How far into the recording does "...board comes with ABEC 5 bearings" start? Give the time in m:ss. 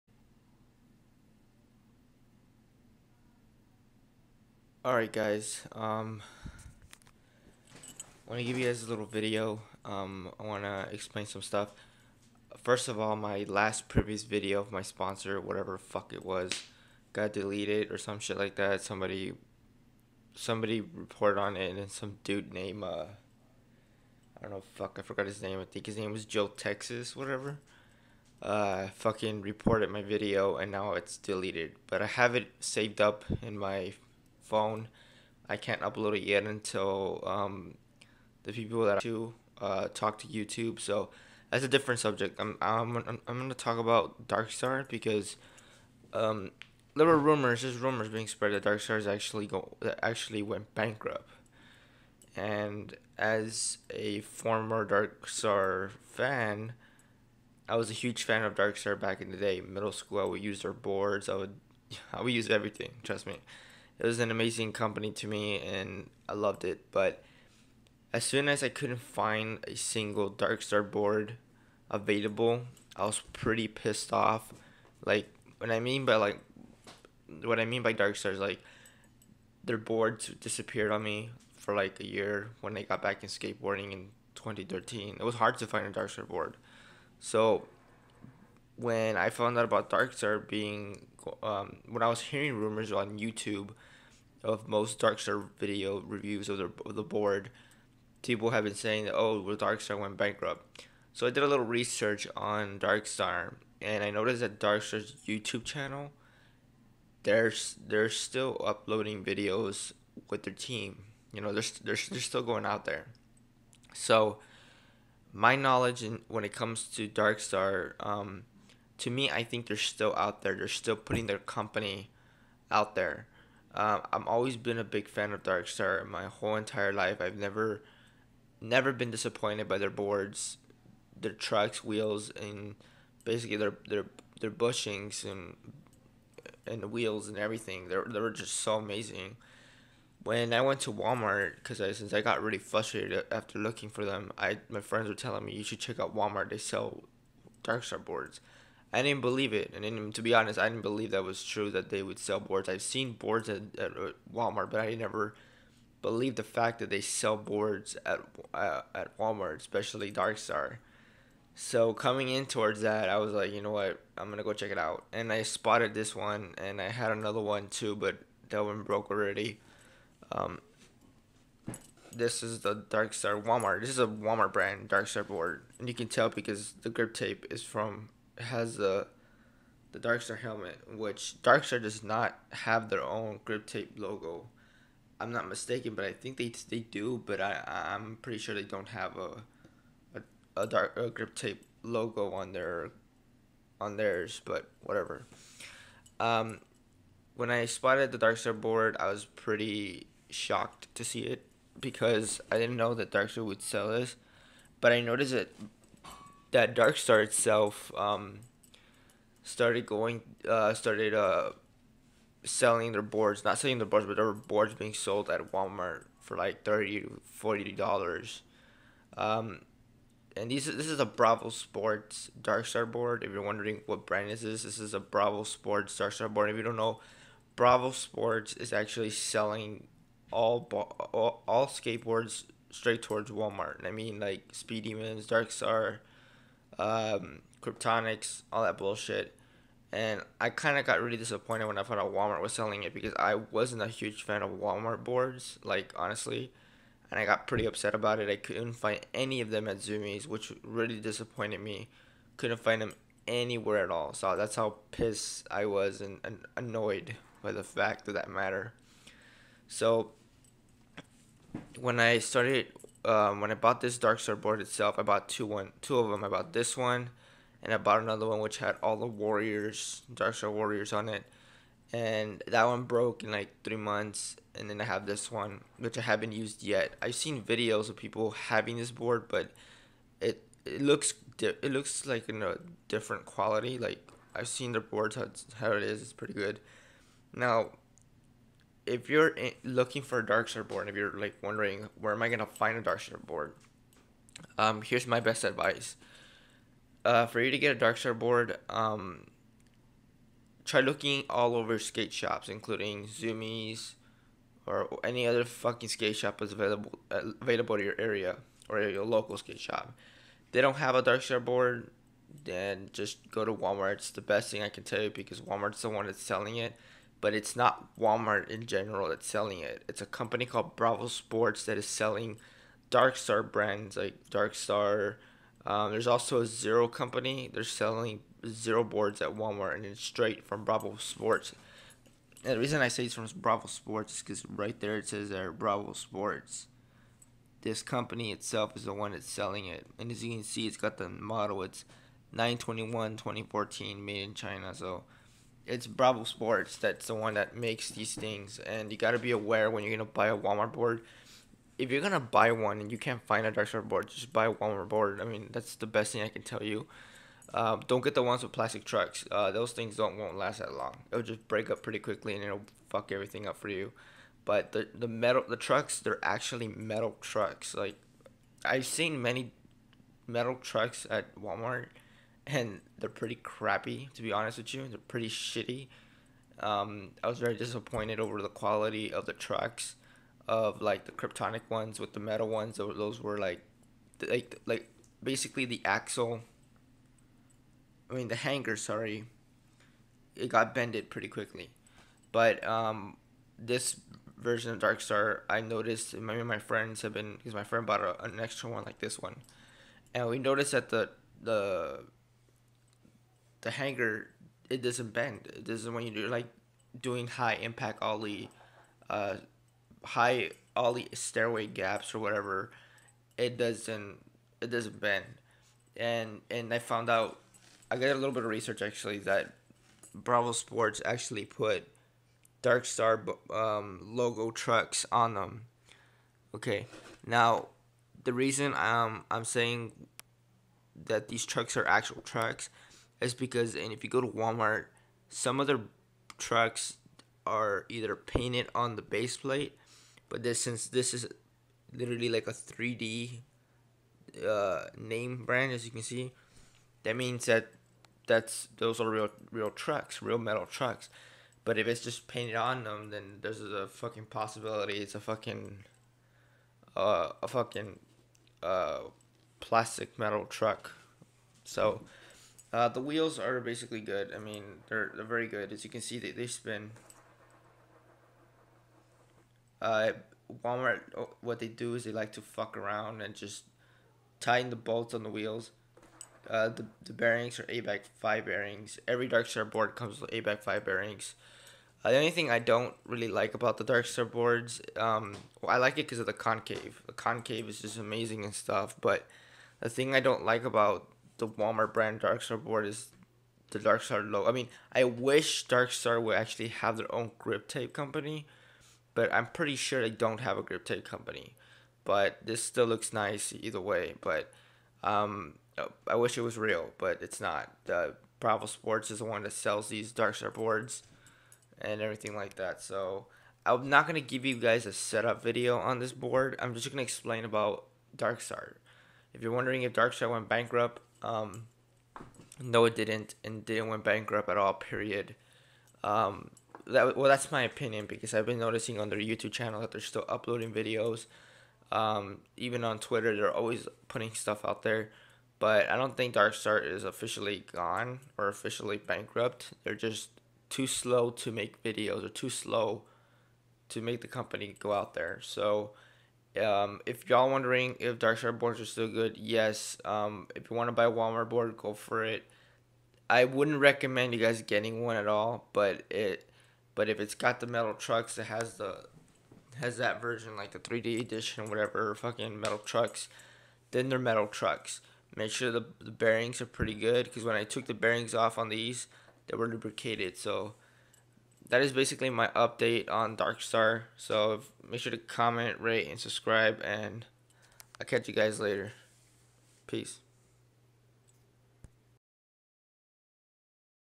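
7:59.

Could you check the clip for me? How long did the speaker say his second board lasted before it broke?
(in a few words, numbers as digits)
3 months.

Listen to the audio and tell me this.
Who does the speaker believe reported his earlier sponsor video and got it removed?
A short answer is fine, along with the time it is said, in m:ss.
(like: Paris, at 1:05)
Joe Texas, at 0:26.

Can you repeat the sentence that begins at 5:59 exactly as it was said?
Uh, those things don't won't last that long.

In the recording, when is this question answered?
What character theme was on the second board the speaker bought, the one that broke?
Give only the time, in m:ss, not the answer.
4:30.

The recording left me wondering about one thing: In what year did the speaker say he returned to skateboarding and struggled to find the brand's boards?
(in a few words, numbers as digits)
2013.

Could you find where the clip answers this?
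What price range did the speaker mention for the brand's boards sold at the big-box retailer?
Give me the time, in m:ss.
3:36.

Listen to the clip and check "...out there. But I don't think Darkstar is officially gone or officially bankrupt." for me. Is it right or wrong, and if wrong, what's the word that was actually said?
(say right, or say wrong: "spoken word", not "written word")
right.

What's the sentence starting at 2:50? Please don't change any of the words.
Um, this is the Darkstar Walmart.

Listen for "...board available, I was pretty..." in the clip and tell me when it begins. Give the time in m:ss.
1:10.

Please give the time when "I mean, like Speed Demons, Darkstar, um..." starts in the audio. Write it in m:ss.
3:53.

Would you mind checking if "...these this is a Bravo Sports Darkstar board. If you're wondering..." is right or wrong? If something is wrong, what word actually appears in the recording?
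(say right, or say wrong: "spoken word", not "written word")
right.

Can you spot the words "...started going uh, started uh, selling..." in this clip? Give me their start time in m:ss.
3:29.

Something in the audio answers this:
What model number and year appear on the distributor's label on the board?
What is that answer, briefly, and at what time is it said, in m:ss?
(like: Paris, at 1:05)
921 2014, at 5:42.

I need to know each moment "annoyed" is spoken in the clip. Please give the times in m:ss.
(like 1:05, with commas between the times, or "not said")
4:16.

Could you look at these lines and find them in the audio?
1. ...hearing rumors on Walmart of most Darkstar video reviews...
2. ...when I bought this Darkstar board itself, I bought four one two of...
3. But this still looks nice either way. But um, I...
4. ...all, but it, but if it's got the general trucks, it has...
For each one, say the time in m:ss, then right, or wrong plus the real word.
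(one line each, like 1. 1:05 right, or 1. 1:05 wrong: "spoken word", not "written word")
1. 1:32 wrong: "YouTube", not "Walmart"
2. 4:23 wrong: "two", not "four"
3. 8:22 right
4. 9:15 wrong: "metal", not "general".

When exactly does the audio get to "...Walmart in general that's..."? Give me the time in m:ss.
5:17.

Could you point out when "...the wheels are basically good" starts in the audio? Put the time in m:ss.
7:42.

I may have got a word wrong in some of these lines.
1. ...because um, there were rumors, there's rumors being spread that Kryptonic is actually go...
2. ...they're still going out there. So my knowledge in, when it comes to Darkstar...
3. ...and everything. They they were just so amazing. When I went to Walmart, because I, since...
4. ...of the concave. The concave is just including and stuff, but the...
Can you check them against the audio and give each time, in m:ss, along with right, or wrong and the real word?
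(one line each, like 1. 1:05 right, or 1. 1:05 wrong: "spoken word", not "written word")
1. 0:44 wrong: "Dark", not "Kryptonic"
2. 1:52 right
3. 2:17 right
4. 8:06 wrong: "amazing", not "including".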